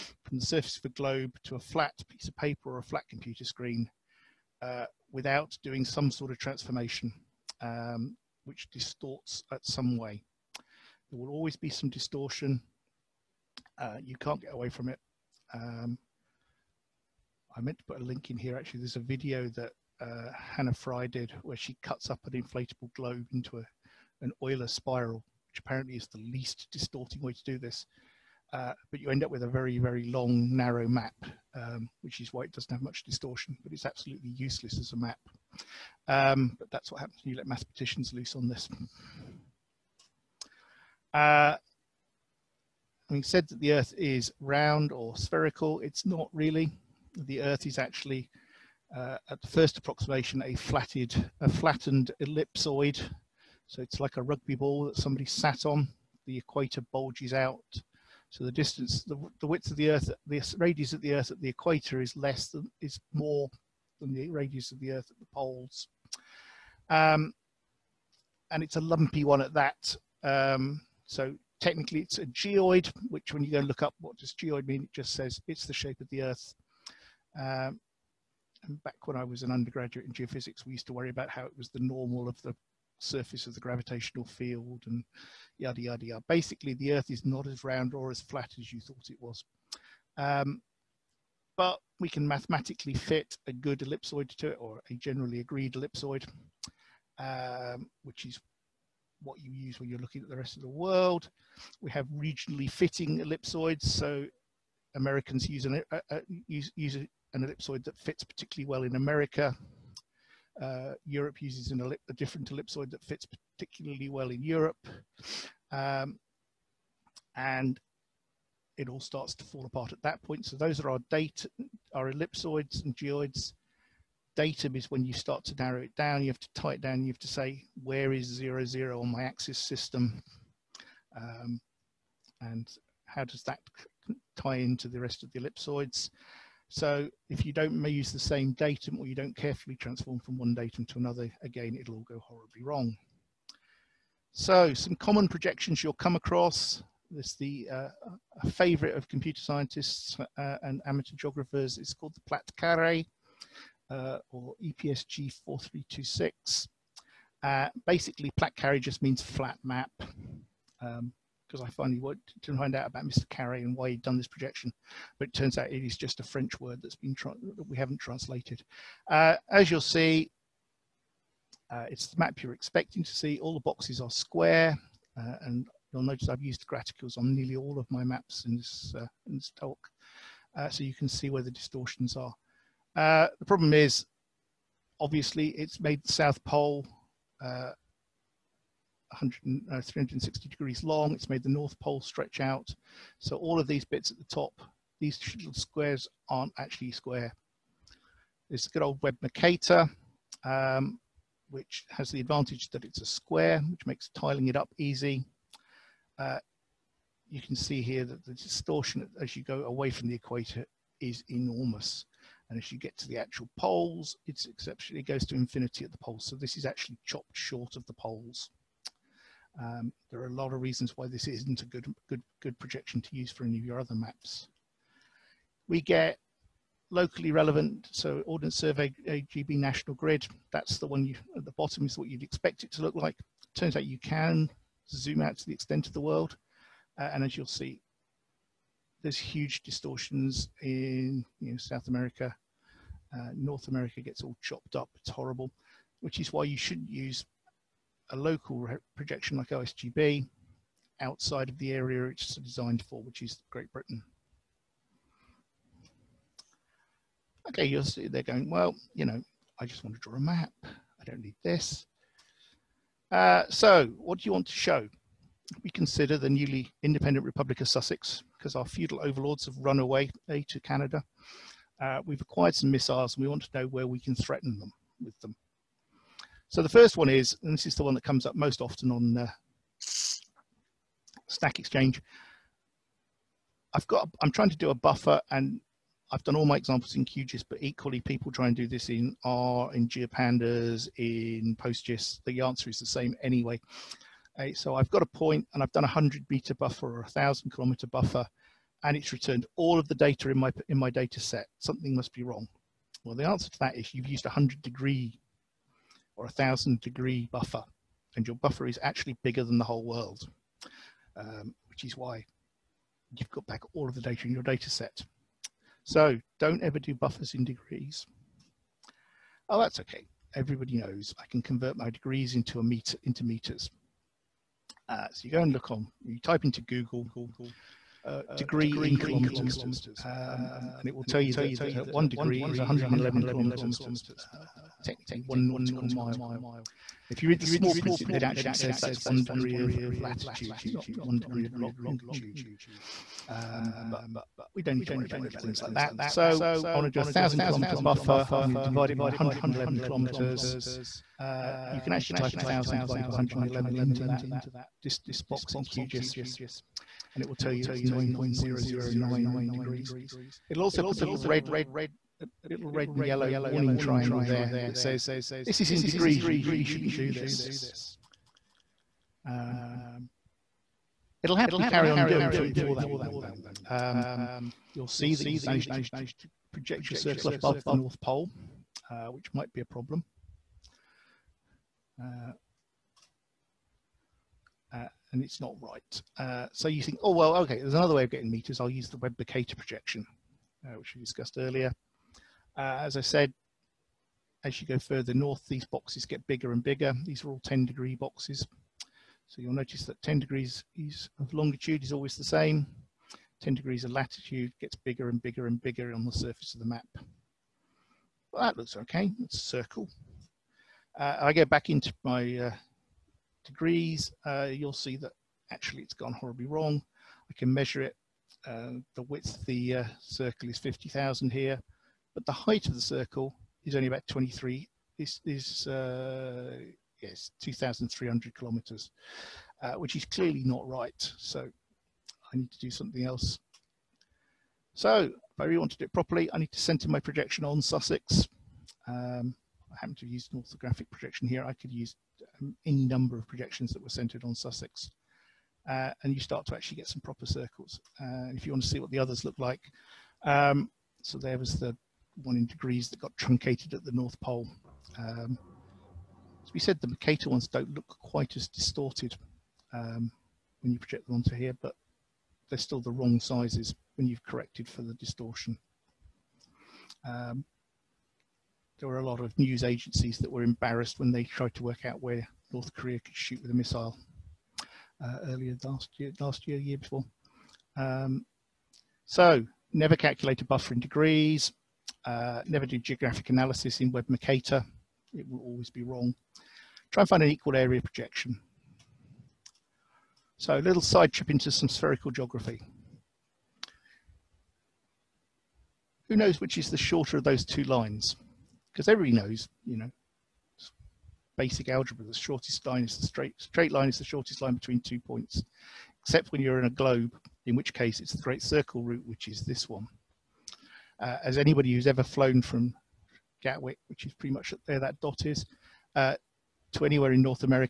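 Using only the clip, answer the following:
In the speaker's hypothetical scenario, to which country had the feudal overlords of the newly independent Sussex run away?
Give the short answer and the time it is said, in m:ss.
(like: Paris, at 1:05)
Canada, at 4:30.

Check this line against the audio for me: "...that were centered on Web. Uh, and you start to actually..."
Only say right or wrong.
wrong.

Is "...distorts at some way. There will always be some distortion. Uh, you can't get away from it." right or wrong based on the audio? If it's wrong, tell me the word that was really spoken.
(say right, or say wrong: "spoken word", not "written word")
right.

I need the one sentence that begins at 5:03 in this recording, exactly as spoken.
Well, the answer to that is you've used a 100 degree or a thousand degree buffer.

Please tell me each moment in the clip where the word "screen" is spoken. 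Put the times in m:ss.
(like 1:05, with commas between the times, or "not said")
0:03.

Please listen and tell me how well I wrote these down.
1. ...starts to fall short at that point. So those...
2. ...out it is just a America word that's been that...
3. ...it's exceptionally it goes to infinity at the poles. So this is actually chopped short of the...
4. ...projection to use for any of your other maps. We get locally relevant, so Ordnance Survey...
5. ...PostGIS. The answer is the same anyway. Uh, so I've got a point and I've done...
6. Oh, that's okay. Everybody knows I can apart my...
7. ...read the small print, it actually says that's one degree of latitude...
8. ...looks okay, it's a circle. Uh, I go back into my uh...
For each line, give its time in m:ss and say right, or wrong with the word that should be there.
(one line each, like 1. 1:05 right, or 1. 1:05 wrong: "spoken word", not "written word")
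1. 1:58 wrong: "apart", not "short"
2. 2:45 wrong: "French", not "America"
3. 3:34 right
4. 3:42 right
5. 4:51 right
6. 5:19 wrong: "convert", not "apart"
7. 5:37 right
8. 6:48 right.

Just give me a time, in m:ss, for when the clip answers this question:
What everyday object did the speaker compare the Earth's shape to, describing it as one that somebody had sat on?
0:54.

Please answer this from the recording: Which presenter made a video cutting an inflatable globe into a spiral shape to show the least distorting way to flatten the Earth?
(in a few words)
Hannah Fry.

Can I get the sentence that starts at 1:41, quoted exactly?
We have regionally fitting ellipsoids, so Americans use, an, uh, uh, use, use an ellipsoid that fits particularly well in America.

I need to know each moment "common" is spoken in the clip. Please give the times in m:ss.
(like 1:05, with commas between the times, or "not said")
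2:24.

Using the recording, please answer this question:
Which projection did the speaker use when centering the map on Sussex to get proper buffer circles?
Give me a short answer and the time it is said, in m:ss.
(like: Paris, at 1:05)
orthographic projection, at 7:20.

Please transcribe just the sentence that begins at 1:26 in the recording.
Basically, the Earth is not as round or as flat as you thought it was.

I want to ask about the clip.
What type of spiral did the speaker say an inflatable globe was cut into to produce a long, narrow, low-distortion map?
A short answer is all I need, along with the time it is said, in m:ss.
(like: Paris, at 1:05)
Euler spiral, at 0:24.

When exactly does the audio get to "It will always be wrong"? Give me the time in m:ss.
8:05.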